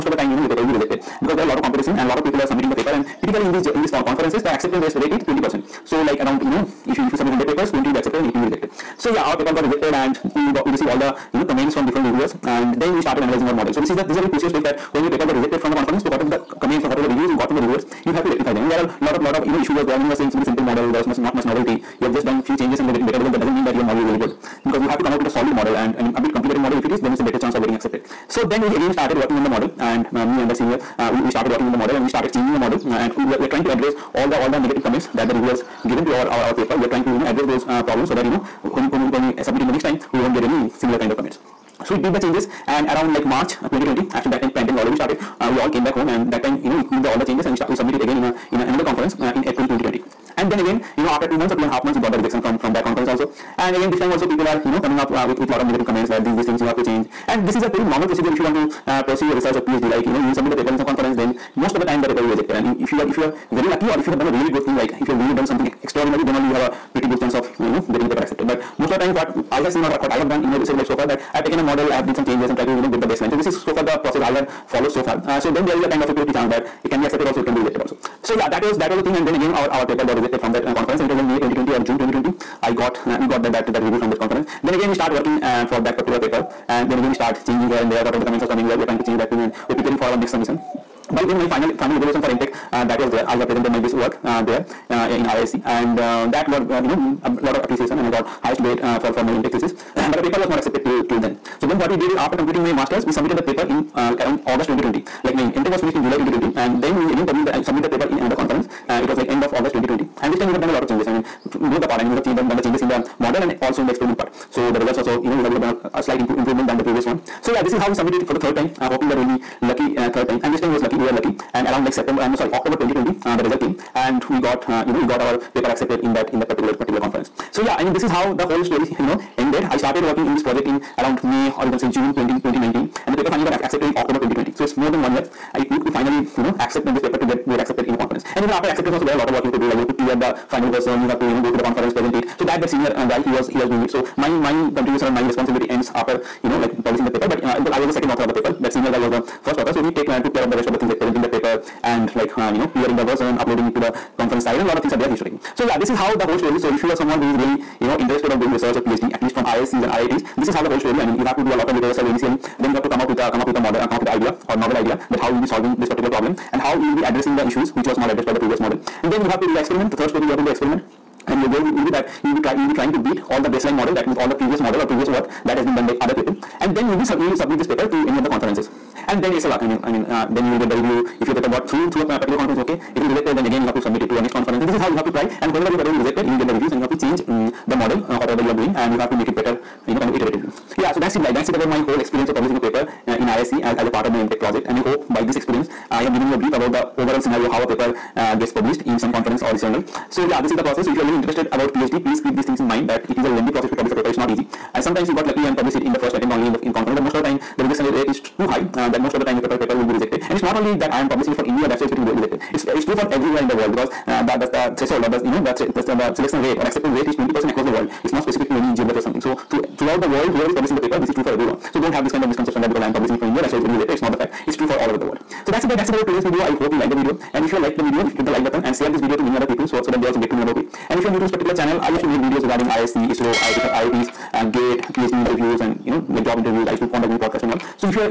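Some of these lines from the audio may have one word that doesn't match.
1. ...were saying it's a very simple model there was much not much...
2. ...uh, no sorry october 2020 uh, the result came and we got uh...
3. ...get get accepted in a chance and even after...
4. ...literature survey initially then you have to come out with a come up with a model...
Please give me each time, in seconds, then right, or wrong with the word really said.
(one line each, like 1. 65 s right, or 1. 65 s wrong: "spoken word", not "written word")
1. 20 s right
2. 122 s right
3. 137 s wrong: "conference", not "chance"
4. 161 s right.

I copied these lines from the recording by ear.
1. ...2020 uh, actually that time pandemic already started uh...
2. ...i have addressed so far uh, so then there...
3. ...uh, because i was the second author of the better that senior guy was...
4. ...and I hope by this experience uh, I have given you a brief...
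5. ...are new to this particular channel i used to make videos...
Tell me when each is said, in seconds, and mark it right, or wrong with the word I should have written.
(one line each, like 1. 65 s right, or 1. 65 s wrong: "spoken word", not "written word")
1. 43 s right
2. 74 s wrong: "followed", not "addressed"
3. 147 s wrong: "paper", not "better"
4. 194 s right
5. 231 s right.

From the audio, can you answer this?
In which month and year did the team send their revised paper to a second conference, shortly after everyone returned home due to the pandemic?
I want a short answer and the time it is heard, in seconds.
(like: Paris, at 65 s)
April 2020, at 49 s.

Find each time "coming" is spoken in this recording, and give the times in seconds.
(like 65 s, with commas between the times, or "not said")
54 s, 88 s.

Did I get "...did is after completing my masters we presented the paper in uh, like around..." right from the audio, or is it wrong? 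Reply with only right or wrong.
wrong.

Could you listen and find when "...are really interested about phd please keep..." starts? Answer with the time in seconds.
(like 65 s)
200 s.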